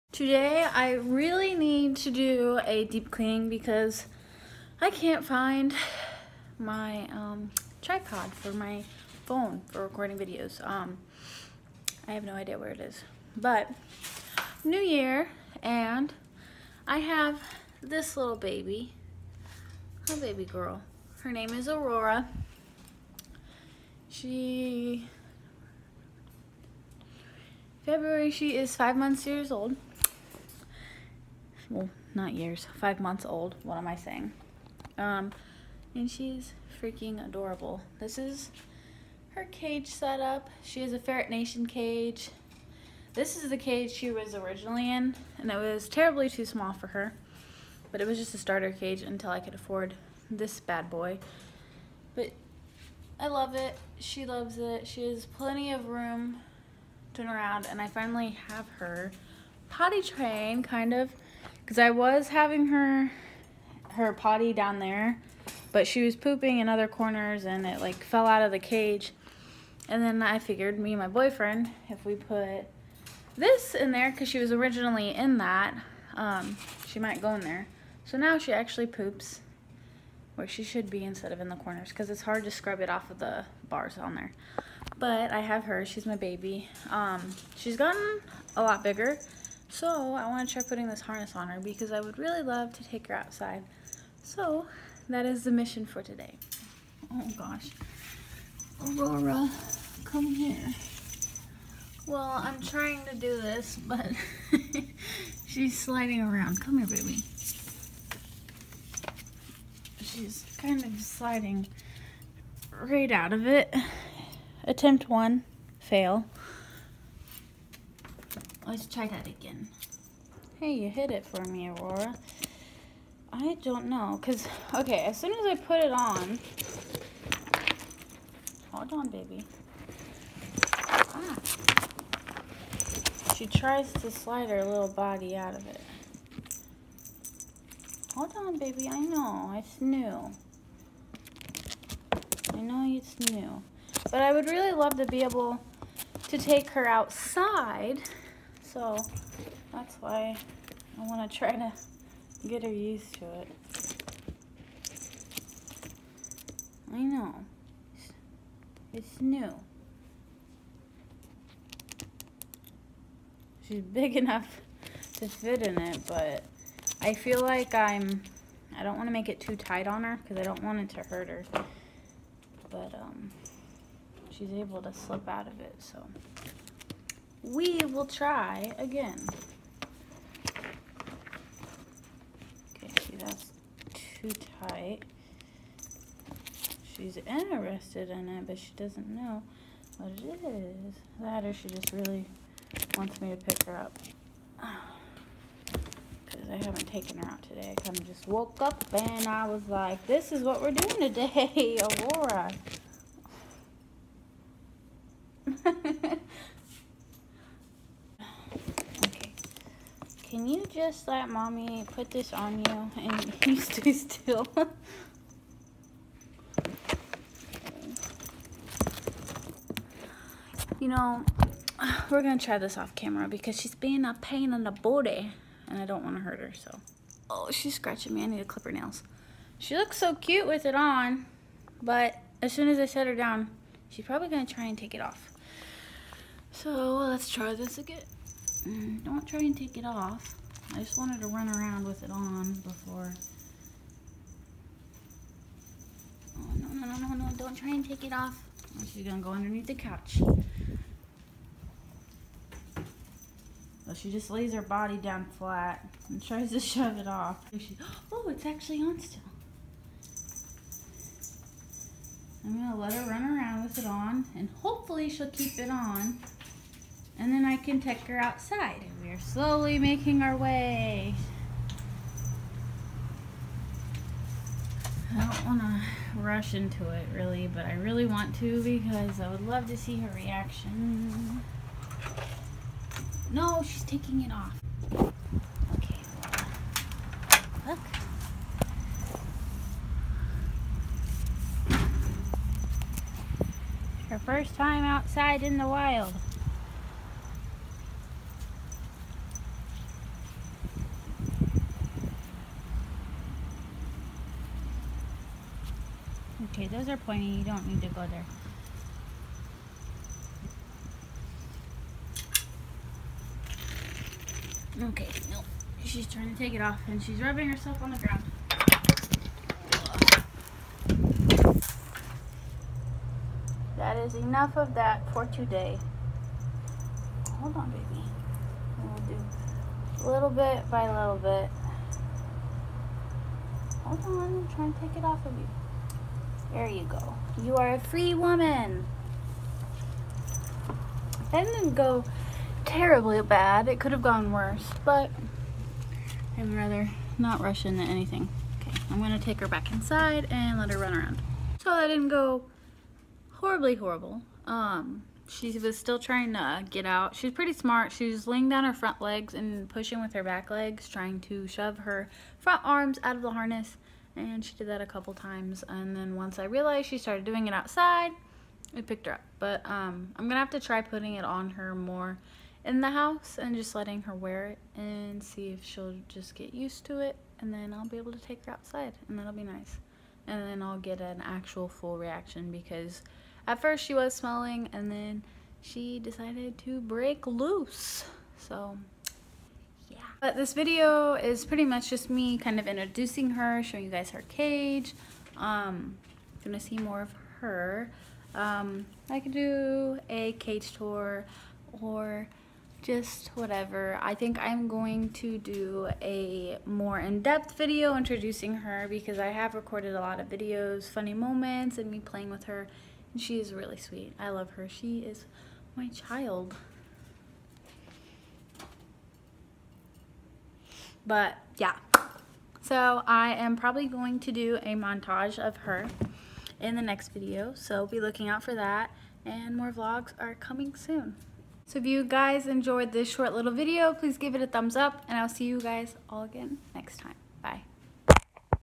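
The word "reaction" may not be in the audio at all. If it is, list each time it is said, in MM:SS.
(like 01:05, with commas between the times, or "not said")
04:40, 06:21.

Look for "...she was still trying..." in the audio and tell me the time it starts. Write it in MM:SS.
05:55.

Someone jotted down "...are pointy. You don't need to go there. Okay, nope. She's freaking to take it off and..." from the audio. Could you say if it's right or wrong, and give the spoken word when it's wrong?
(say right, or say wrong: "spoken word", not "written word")
wrong: "trying", not "freaking".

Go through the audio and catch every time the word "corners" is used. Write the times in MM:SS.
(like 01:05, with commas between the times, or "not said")
01:06, 01:21.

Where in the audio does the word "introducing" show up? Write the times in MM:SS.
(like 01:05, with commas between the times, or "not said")
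06:32, 06:47.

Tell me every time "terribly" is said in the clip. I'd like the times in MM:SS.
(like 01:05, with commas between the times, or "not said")
00:45, 05:42.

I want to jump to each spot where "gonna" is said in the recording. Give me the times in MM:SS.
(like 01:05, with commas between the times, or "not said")
03:42, 03:54, 04:09, 04:22, 05:49, 06:10, 06:36.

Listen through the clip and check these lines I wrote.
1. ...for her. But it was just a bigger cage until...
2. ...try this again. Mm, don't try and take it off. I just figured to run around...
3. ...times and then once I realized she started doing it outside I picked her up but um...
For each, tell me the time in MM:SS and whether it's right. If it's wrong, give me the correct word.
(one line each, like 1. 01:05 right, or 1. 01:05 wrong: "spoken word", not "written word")
1. 00:46 wrong: "starter", not "bigger"
2. 03:57 wrong: "wanted", not "figured"
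3. 06:05 right.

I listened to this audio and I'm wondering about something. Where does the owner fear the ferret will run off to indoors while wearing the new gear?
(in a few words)
Underneath the couch.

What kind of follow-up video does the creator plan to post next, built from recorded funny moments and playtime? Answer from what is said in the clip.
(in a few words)
A montage.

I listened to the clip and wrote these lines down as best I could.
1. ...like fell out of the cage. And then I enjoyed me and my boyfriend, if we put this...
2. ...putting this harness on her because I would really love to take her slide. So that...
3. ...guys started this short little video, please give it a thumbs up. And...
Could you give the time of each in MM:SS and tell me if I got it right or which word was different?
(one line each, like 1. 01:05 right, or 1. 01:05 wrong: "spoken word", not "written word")
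1. 01:07 wrong: "figured", not "enjoyed"
2. 01:30 wrong: "outside", not "slide"
3. 07:12 wrong: "enjoyed", not "started".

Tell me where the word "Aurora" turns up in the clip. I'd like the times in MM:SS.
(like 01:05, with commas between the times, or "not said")
00:21, 01:38, 02:01, 03:22.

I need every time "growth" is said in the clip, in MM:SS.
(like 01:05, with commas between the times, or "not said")
not said.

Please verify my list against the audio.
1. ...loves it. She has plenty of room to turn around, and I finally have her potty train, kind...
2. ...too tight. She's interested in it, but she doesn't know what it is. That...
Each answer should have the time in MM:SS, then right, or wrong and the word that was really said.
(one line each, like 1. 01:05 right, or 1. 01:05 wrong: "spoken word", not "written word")
1. 00:54 right
2. 03:04 right.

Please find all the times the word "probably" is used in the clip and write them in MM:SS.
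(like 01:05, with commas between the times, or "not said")
03:54, 07:03.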